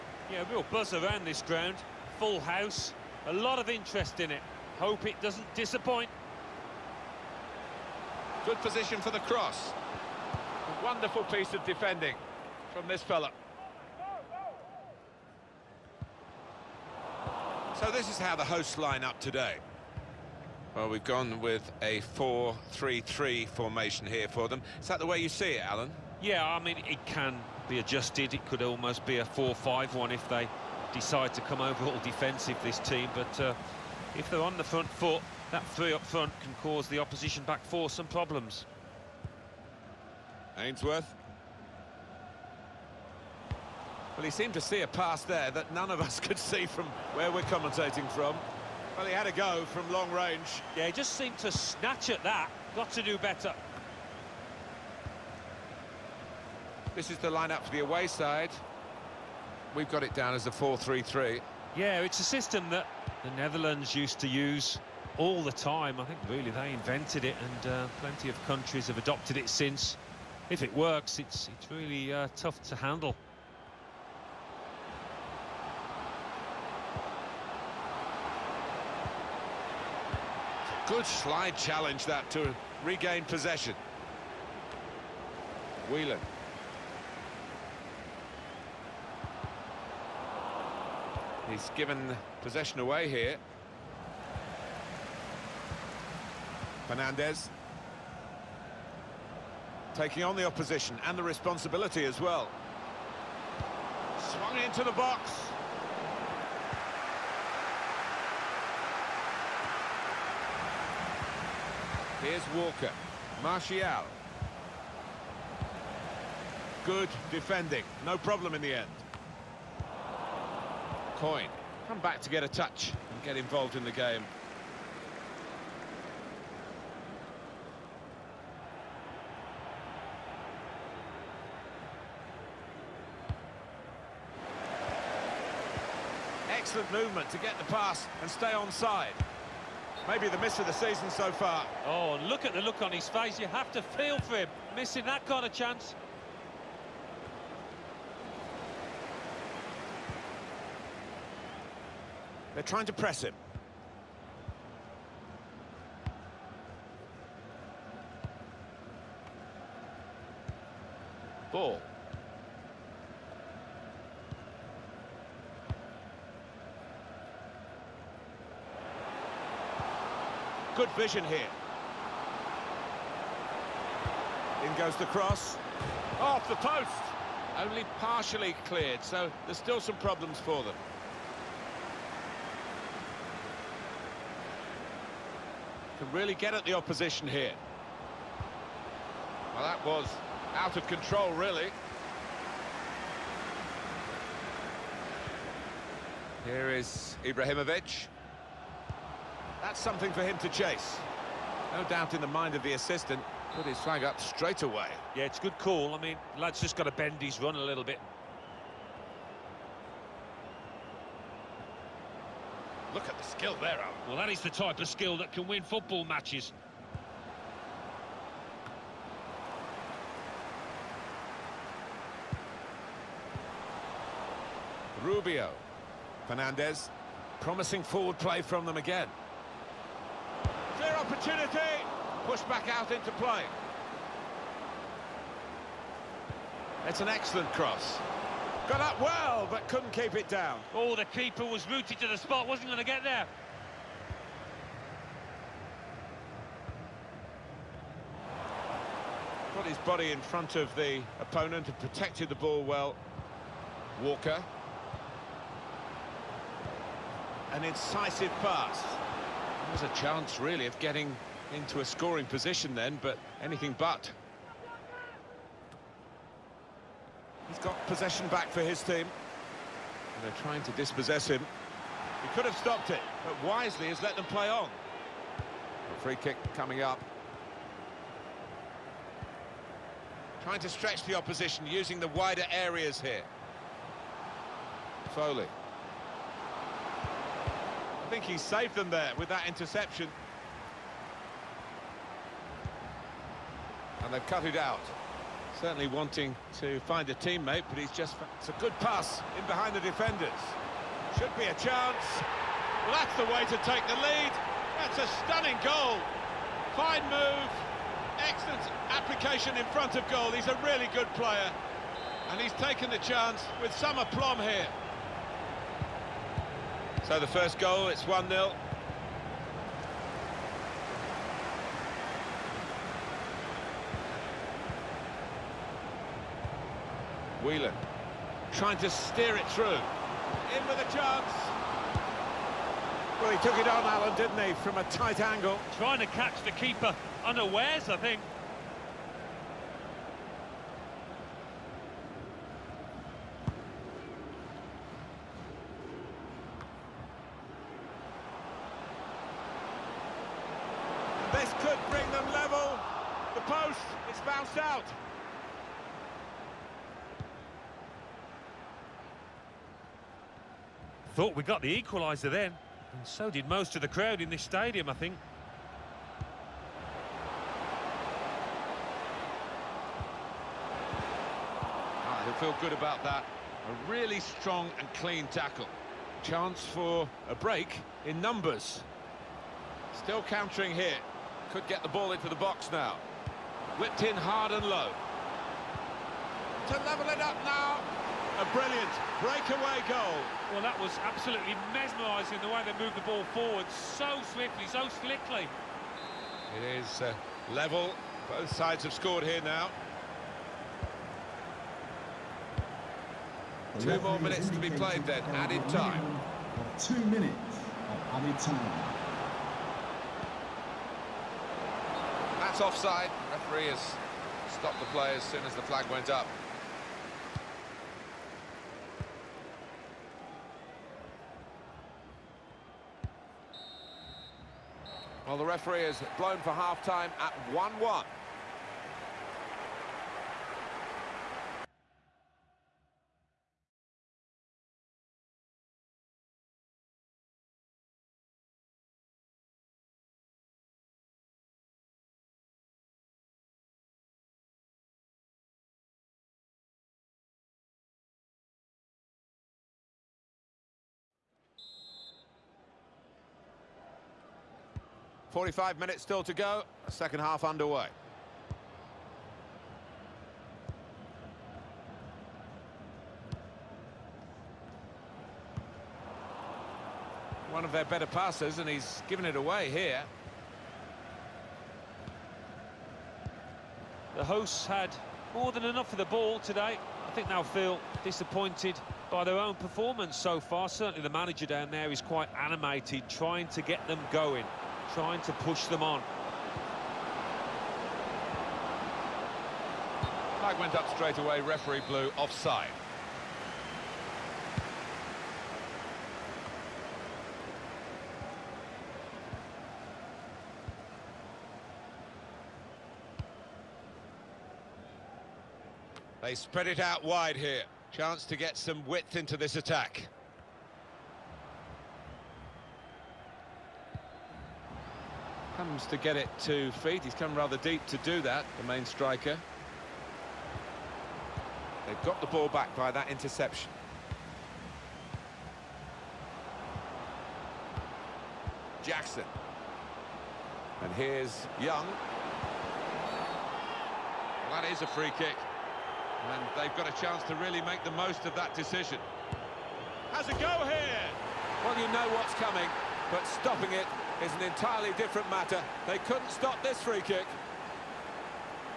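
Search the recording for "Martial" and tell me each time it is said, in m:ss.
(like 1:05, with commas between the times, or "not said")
1:53.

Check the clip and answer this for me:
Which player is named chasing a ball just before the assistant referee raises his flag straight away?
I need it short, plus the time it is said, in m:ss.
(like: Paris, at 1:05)
Ibrahimovic, at 3:17.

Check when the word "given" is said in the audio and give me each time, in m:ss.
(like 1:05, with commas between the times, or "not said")
1:31, 7:49.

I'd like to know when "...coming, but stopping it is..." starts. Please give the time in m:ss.
9:02.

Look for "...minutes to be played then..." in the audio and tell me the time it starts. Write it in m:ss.
6:44.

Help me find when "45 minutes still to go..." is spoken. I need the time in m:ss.
7:35.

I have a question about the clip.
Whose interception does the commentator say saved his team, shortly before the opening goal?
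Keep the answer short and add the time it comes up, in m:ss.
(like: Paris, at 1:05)
Foley, at 4:45.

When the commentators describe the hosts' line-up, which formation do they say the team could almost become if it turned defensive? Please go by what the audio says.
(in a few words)
4-5-1.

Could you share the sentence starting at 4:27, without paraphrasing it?
He's got possession back for his team.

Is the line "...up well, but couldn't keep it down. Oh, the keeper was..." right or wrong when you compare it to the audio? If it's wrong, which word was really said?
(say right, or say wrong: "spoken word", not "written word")
right.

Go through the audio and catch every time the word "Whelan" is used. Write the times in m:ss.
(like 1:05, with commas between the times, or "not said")
1:25, 5:27.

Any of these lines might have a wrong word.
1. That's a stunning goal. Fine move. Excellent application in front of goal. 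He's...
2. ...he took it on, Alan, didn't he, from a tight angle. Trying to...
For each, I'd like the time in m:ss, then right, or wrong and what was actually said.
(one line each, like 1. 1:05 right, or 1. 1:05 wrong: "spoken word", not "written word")
1. 5:04 right
2. 5:33 right.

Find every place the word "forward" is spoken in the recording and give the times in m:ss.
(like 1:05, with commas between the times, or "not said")
3:47, 6:33.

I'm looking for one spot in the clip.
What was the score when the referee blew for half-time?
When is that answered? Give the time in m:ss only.
7:07.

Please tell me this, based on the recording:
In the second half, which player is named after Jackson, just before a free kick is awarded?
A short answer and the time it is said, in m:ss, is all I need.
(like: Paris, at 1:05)
Young, at 8:51.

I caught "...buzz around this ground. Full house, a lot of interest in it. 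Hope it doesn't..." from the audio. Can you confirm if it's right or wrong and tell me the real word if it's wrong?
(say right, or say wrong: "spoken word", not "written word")
right.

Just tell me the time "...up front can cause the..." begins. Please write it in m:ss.
0:35.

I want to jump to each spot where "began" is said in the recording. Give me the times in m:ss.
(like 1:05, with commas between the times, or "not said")
not said.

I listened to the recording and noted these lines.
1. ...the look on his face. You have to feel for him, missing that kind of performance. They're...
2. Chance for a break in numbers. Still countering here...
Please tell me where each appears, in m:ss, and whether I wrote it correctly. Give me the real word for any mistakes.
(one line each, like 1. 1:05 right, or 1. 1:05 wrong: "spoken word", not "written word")
1. 2:22 wrong: "chance", not "performance"
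2. 6:16 right.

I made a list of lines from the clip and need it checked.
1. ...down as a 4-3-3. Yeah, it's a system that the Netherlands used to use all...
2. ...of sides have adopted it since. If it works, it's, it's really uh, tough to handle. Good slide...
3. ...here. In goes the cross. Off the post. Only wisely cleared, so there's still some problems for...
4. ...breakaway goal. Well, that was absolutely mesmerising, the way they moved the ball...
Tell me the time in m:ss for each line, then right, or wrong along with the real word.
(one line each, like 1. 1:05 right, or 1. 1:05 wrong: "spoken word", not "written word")
1. 1:00 right
2. 1:08 wrong: "countries", not "sides"
3. 2:51 wrong: "partially", not "wisely"
4. 6:29 right.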